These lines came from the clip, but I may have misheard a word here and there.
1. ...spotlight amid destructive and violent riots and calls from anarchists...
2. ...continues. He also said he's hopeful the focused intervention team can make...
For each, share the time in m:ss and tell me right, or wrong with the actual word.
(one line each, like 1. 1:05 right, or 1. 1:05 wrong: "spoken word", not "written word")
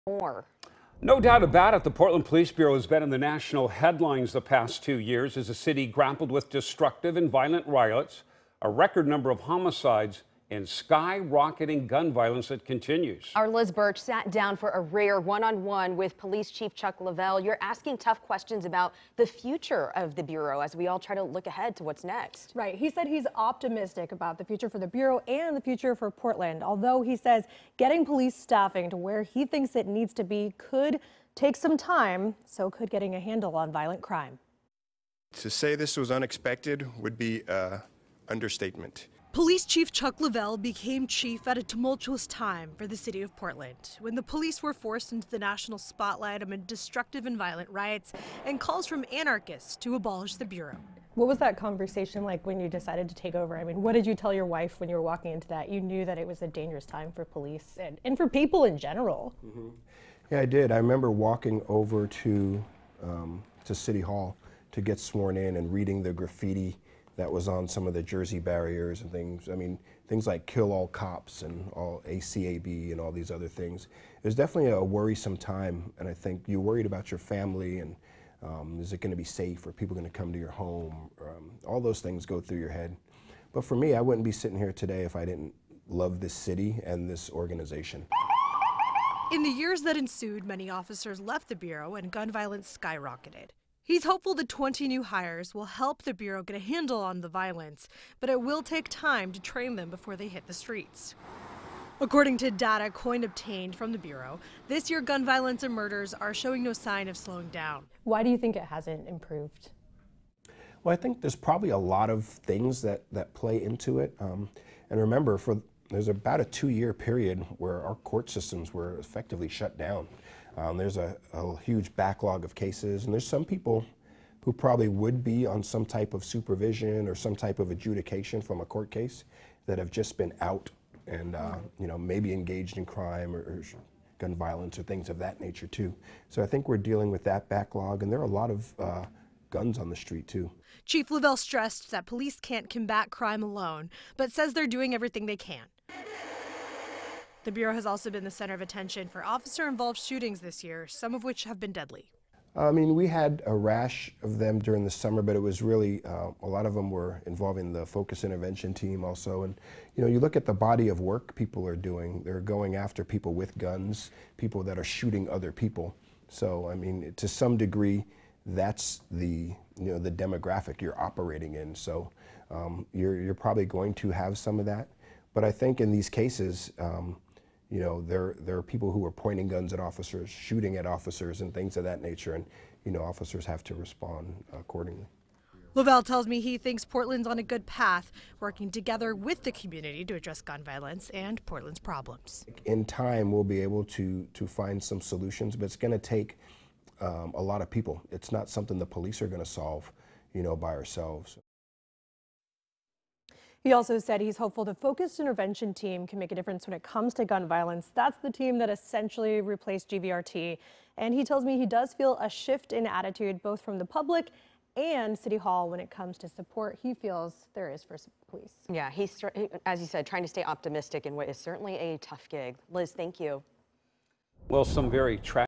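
1. 0:45 right
2. 3:20 wrong: "ourselves", not "continues".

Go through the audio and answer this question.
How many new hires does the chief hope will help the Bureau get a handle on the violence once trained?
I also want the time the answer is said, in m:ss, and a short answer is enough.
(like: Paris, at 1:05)
20, at 1:34.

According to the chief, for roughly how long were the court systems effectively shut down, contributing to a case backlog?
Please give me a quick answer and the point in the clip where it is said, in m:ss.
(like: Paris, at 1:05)
2 years, at 1:56.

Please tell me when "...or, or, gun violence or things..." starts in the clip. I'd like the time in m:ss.
2:13.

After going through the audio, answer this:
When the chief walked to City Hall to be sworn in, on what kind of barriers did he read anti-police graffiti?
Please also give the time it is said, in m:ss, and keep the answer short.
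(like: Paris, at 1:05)
Jersey barriers, at 1:08.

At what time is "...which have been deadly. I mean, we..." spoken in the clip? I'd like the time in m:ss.
2:31.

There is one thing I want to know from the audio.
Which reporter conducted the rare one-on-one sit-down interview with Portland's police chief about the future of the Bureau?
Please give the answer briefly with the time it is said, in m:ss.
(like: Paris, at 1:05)
Liz Birch, at 0:13.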